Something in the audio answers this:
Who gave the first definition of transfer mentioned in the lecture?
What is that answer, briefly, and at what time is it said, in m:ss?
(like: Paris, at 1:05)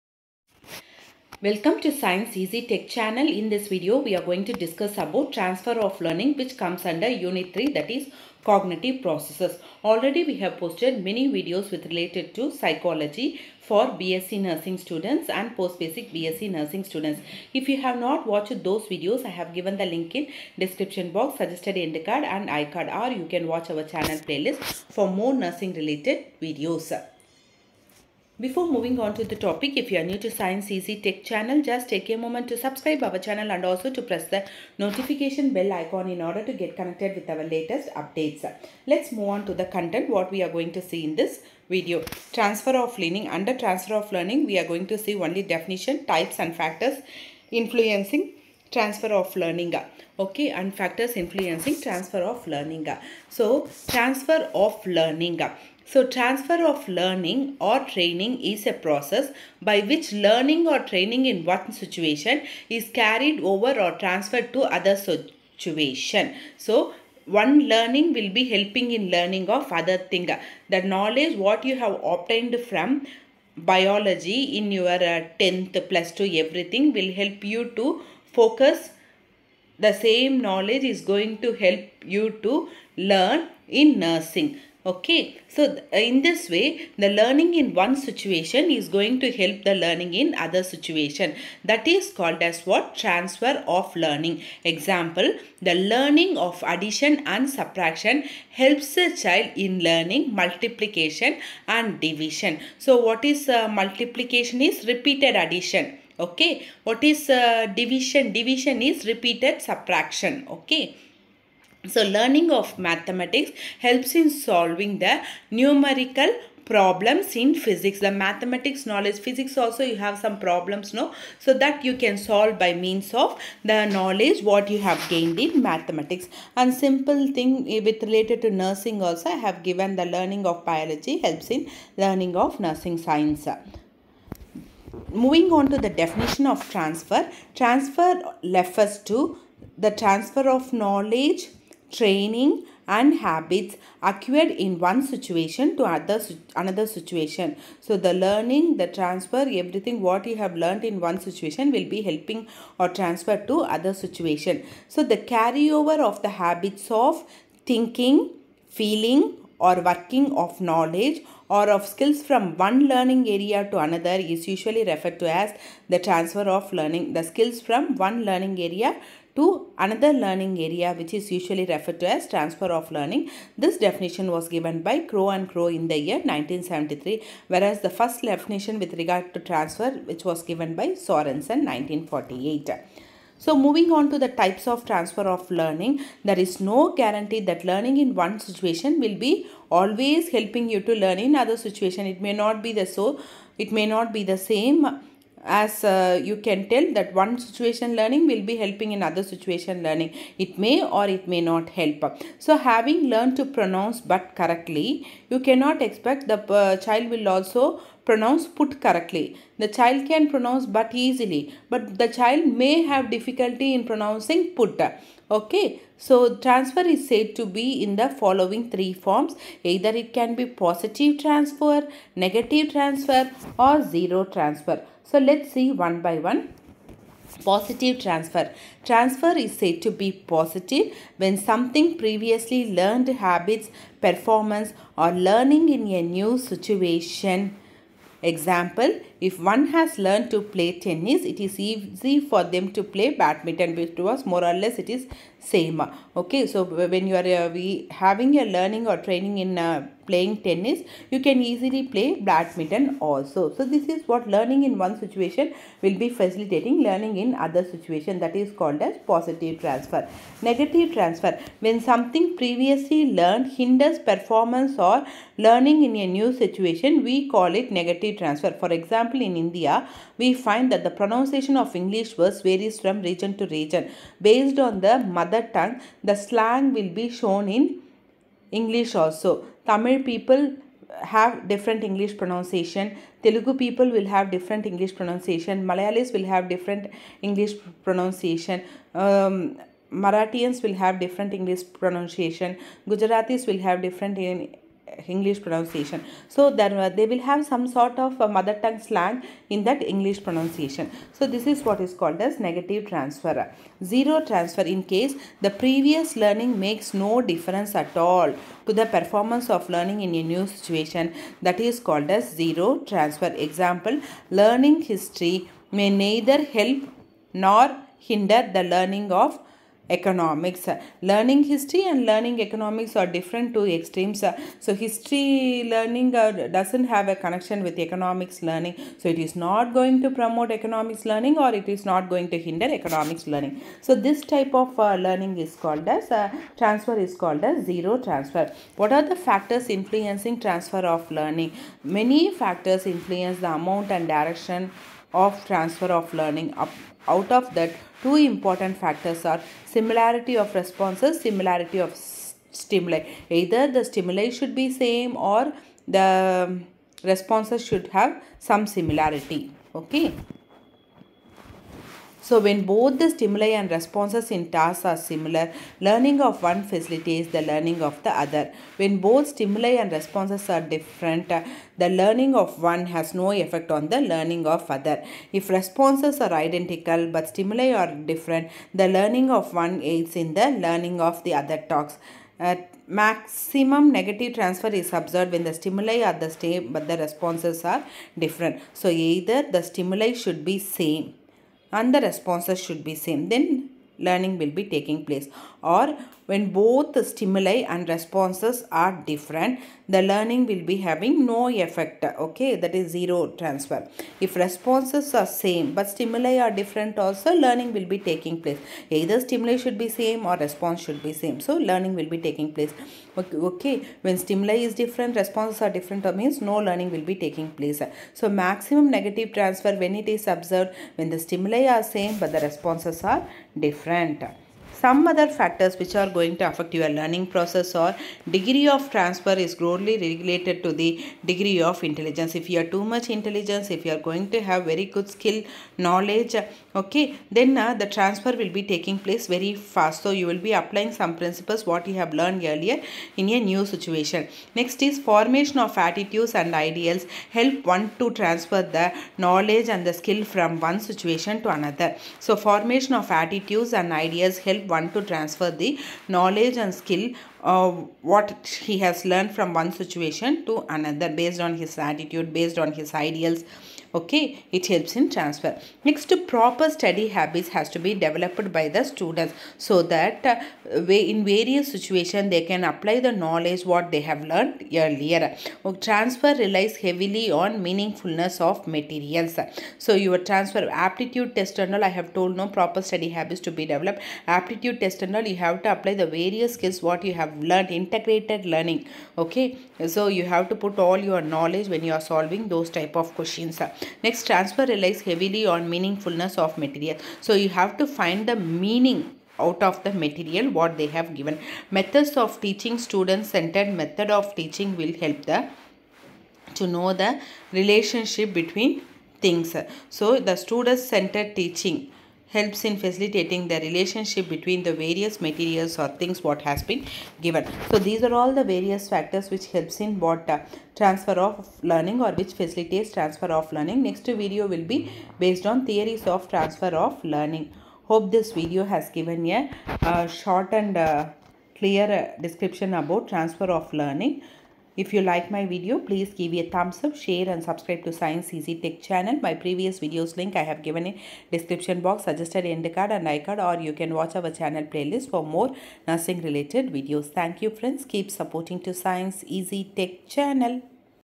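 Sorenson, at 3:00.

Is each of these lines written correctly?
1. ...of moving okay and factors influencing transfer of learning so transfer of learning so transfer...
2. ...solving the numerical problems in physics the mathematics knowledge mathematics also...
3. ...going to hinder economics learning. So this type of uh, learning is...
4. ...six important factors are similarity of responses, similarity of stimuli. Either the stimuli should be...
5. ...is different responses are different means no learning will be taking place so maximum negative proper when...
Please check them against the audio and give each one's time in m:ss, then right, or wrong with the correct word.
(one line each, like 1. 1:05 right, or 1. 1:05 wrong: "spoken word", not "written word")
1. 0:49 wrong: "learning", not "moving"
2. 1:54 wrong: "physics", not "mathematics"
3. 5:32 right
4. 5:48 wrong: "two", not "six"
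5. 6:54 wrong: "transfer", not "proper".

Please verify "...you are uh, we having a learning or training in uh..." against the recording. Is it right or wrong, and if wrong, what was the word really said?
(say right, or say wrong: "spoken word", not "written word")
right.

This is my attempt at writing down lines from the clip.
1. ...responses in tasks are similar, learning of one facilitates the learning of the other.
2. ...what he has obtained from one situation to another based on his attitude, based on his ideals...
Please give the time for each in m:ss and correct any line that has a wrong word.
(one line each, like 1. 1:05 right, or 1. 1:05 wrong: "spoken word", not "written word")
1. 6:03 right
2. 7:38 wrong: "learned", not "obtained".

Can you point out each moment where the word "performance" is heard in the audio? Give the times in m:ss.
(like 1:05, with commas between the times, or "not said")
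3:53, 4:23, 5:08.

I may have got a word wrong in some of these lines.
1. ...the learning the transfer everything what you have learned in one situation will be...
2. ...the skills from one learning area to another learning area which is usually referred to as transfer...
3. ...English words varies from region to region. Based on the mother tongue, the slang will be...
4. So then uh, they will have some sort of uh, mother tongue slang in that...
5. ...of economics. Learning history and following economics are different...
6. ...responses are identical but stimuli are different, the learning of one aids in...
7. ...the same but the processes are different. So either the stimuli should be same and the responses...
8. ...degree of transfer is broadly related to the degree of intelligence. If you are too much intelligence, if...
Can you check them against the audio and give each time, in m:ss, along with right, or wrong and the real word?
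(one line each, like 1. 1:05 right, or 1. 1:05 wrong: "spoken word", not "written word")
1. 2:28 right
2. 2:47 right
3. 4:31 right
4. 4:56 right
5. 5:19 wrong: "learning", not "following"
6. 6:15 right
7. 6:26 wrong: "responses", not "processes"
8. 7:08 right.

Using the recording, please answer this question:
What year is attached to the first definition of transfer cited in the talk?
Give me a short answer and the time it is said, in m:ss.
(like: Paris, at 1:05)
1948, at 3:01.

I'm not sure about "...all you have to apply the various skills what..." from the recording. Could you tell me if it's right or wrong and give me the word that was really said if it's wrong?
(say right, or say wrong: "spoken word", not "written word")
right.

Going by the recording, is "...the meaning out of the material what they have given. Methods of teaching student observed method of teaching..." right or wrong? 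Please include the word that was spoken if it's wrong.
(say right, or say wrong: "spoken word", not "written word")
wrong: "centered", not "observed".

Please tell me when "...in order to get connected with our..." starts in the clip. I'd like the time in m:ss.
0:36.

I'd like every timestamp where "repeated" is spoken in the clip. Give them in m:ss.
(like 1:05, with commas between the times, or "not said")
1:44, 1:49.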